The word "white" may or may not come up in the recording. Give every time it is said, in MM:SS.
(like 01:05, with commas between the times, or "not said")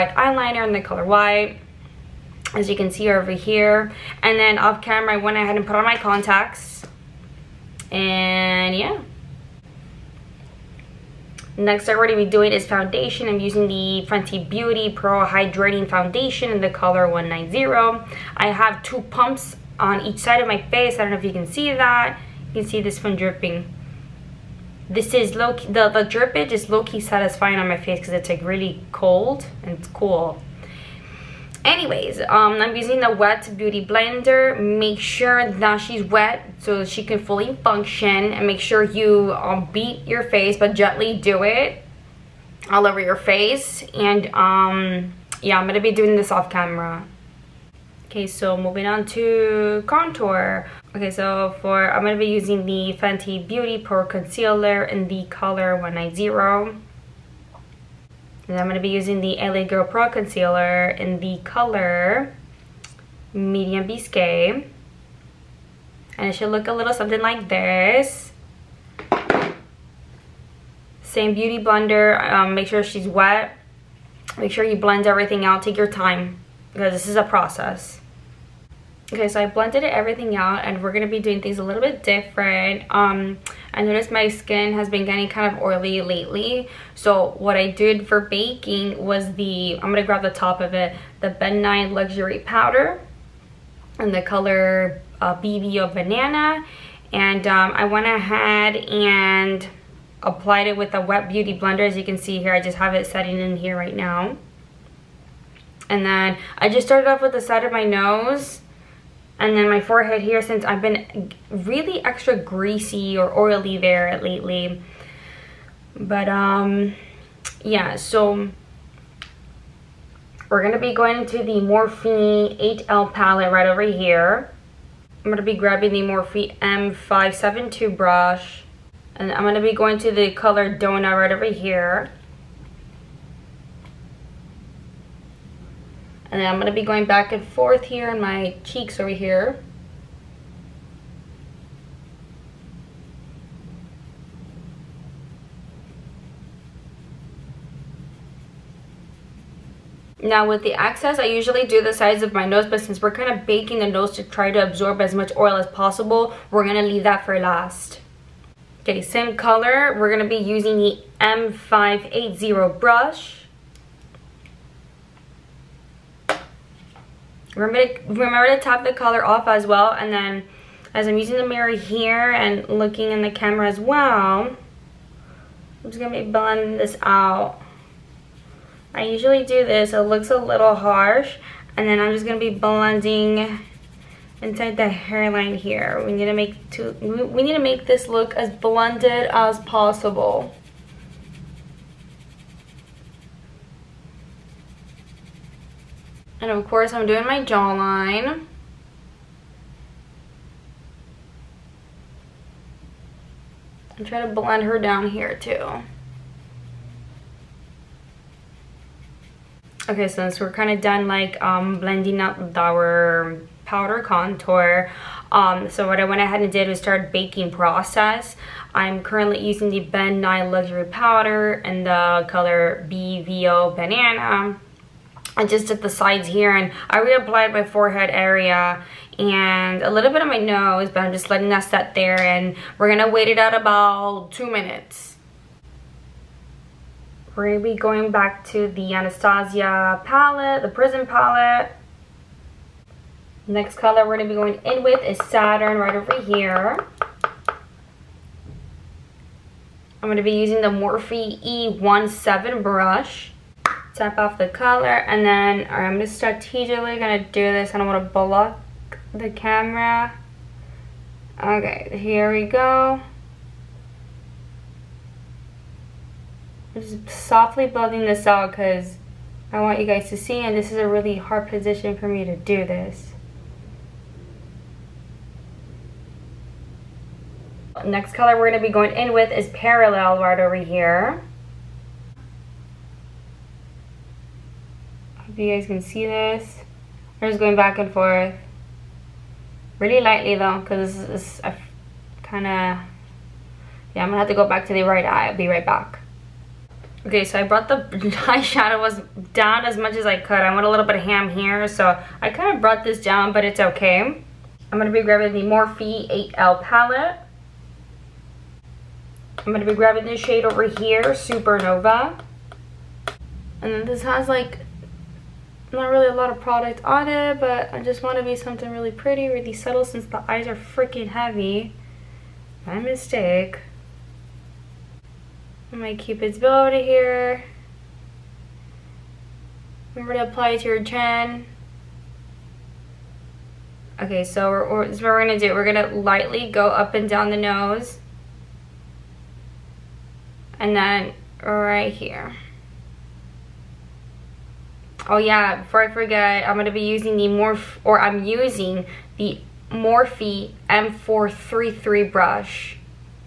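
00:01.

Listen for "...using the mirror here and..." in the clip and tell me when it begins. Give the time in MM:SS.
02:51.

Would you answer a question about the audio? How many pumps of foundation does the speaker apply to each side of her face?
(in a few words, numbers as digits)
2.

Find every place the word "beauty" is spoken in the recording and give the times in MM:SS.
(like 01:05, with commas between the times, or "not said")
00:14, 00:33, 00:53, 01:11, 01:41.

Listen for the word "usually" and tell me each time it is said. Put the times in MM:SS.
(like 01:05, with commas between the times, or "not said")
02:31, 02:59.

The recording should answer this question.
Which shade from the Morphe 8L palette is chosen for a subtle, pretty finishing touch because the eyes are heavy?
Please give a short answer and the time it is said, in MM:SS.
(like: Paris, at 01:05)
Supernova, at 05:11.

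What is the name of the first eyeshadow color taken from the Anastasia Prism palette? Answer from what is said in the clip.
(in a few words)
Saturn.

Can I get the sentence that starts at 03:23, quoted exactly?
I'm trying to blend her down here too.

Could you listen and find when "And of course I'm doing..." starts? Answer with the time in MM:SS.
03:16.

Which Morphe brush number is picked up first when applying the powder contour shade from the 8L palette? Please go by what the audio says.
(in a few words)
M572.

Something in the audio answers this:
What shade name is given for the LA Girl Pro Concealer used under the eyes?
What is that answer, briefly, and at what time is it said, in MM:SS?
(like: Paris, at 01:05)
Medium Bisque, at 01:03.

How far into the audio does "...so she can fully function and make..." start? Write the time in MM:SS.
00:36.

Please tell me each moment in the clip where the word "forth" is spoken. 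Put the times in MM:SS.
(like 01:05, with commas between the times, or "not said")
02:17, 04:47.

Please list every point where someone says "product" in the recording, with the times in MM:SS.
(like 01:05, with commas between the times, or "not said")
05:16.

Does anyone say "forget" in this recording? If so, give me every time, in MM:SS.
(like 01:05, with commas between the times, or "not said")
05:45.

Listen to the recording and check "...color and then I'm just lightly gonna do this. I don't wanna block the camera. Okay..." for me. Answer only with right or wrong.
wrong.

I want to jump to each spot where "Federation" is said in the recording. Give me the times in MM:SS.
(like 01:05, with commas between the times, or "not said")
not said.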